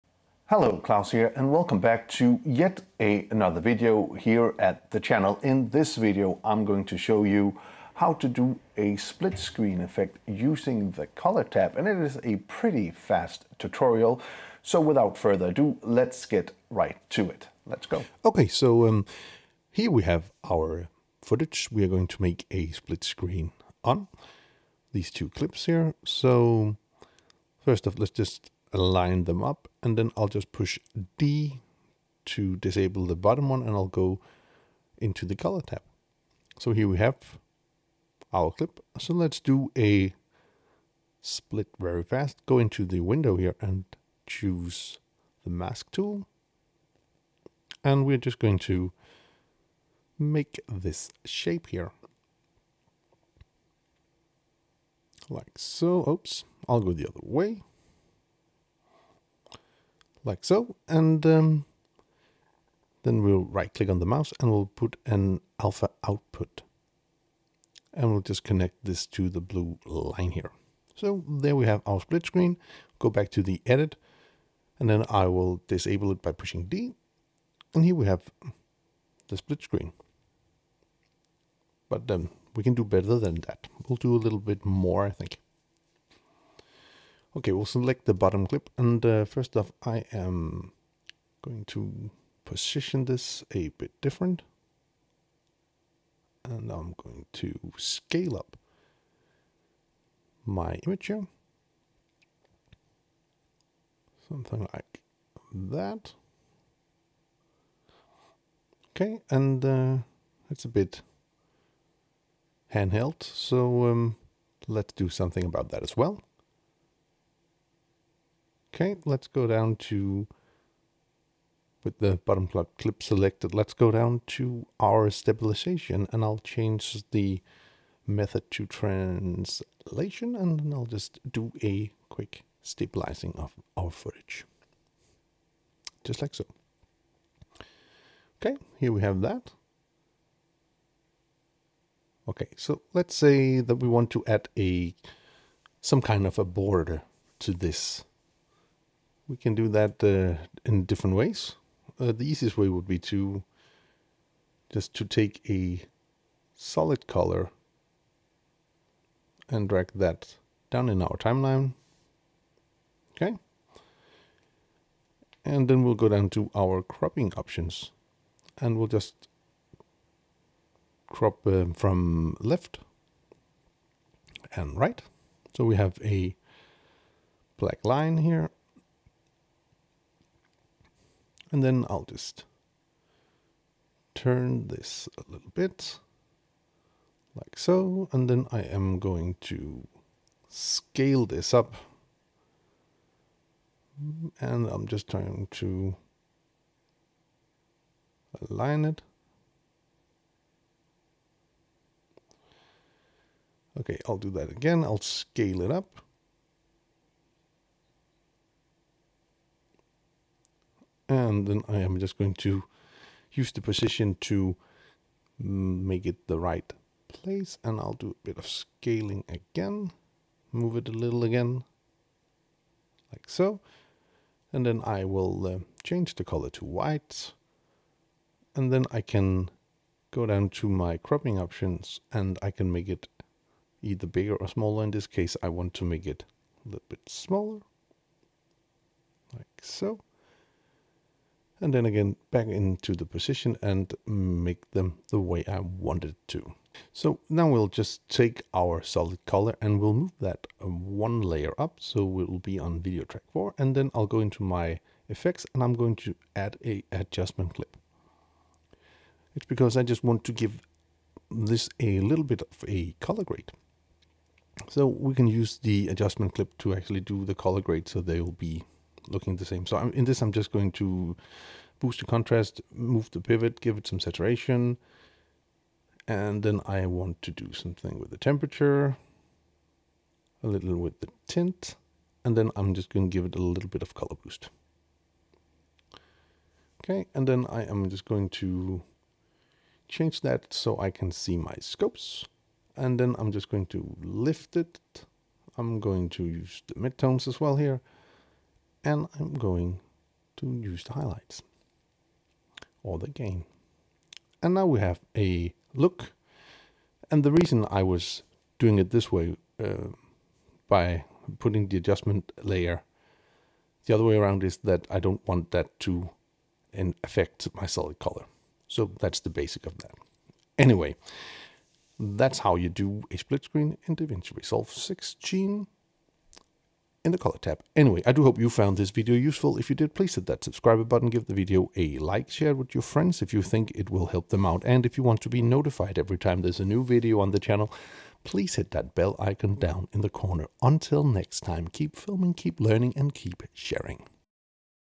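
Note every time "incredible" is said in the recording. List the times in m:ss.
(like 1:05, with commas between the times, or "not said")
not said.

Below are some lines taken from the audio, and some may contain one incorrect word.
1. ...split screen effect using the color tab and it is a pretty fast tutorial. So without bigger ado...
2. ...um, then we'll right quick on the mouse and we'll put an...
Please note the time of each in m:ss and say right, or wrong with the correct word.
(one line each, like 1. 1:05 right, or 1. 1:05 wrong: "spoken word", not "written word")
1. 0:08 wrong: "further", not "bigger"
2. 1:01 wrong: "click", not "quick".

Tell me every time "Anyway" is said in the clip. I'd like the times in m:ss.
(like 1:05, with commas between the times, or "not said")
5:20, 5:27.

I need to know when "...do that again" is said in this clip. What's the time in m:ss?
3:24.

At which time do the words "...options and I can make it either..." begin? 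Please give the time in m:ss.
3:51.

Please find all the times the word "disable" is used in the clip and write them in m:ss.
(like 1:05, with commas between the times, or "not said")
0:32, 1:15.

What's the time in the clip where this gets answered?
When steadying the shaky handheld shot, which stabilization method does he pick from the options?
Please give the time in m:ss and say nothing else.
2:08.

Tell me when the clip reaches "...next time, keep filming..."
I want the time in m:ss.
5:41.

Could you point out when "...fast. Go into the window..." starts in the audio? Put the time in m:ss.
0:42.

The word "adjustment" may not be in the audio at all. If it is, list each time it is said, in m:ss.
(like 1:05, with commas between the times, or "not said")
4:16, 4:25, 5:11.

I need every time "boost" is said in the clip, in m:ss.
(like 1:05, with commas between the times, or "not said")
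4:31, 4:44.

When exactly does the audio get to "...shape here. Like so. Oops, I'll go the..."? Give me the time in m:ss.
0:51.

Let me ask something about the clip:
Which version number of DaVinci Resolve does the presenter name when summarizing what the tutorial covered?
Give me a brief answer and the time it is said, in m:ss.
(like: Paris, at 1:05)
16, at 5:24.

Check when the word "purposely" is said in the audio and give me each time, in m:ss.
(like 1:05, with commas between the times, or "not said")
not said.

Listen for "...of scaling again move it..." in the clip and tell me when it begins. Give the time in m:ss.
3:38.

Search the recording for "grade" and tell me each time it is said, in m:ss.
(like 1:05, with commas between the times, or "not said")
4:23, 4:27.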